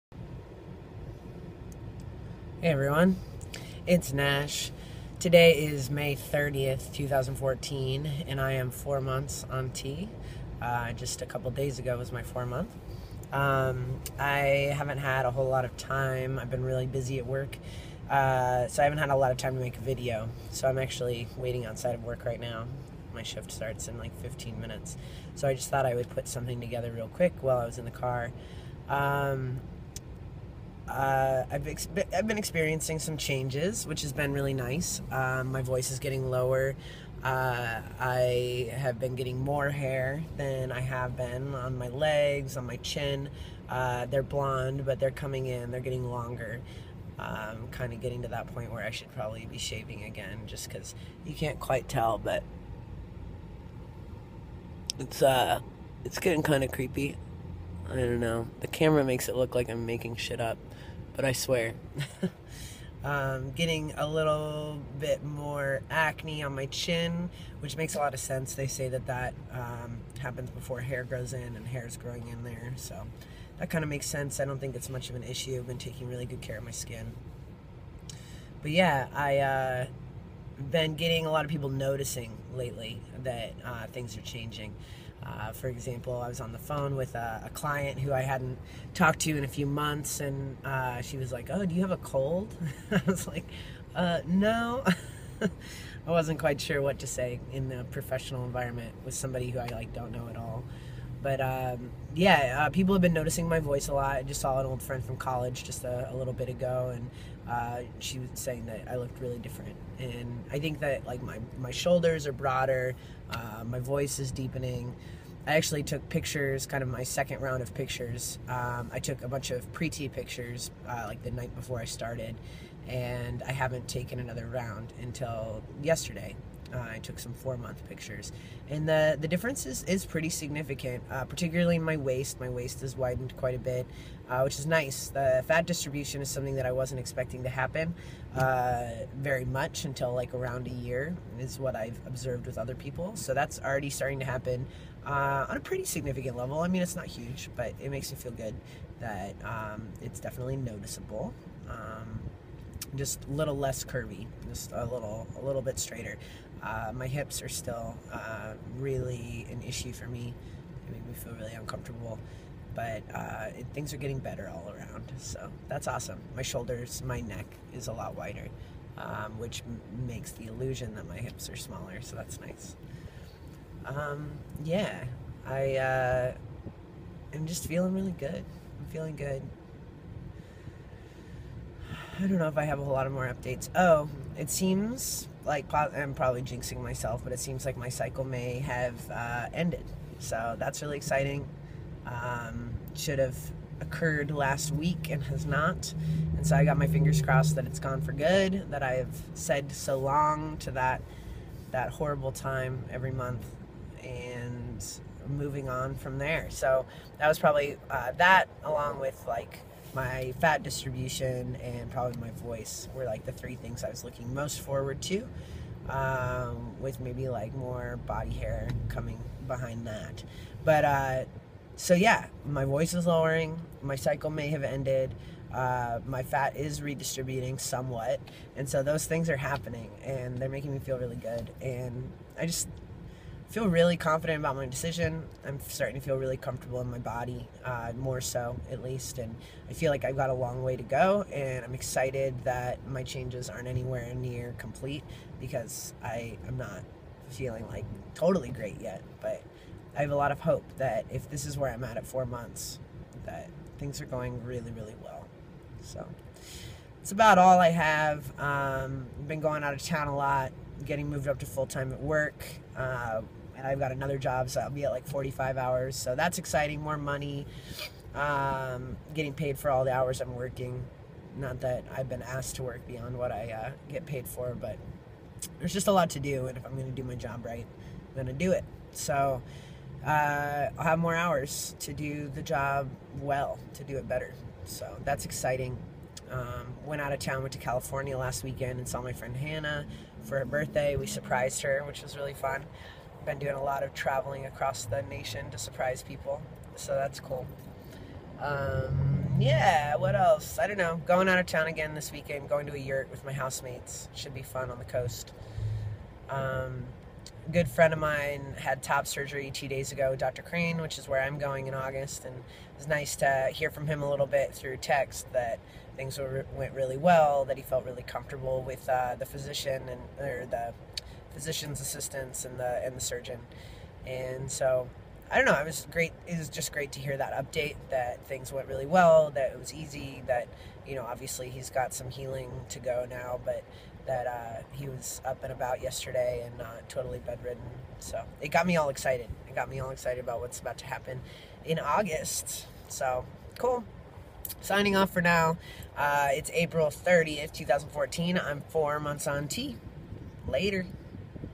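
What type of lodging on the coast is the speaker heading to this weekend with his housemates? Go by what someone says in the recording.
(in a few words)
Yurt.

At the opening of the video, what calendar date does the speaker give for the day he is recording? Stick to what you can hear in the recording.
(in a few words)
May 30th.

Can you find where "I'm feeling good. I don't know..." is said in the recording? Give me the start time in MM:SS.
02:58.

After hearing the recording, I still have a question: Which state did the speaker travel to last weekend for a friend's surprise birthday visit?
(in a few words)
California.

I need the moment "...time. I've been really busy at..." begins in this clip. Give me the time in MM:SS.
00:15.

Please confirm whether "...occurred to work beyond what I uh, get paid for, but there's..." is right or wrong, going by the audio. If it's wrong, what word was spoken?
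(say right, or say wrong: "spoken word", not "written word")
wrong: "asked", not "occurred".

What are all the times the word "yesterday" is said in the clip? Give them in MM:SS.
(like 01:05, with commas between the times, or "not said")
02:05, 05:35.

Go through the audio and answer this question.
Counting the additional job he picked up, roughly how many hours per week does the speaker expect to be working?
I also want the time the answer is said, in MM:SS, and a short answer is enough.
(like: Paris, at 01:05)
45, at 04:25.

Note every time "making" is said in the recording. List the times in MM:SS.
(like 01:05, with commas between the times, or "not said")
00:59, 03:50.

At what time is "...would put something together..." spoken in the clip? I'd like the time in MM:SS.
00:25.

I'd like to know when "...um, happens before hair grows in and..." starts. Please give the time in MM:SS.
01:09.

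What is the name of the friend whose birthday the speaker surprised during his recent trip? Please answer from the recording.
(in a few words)
Hannah.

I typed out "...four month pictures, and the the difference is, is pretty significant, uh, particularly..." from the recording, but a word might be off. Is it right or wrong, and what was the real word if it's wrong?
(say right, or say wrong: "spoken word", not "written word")
right.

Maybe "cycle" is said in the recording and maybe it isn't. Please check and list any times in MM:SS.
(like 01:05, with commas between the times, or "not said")
03:07, 03:43.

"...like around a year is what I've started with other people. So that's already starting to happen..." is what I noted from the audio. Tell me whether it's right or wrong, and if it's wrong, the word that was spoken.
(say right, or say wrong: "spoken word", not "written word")
wrong: "observed", not "started".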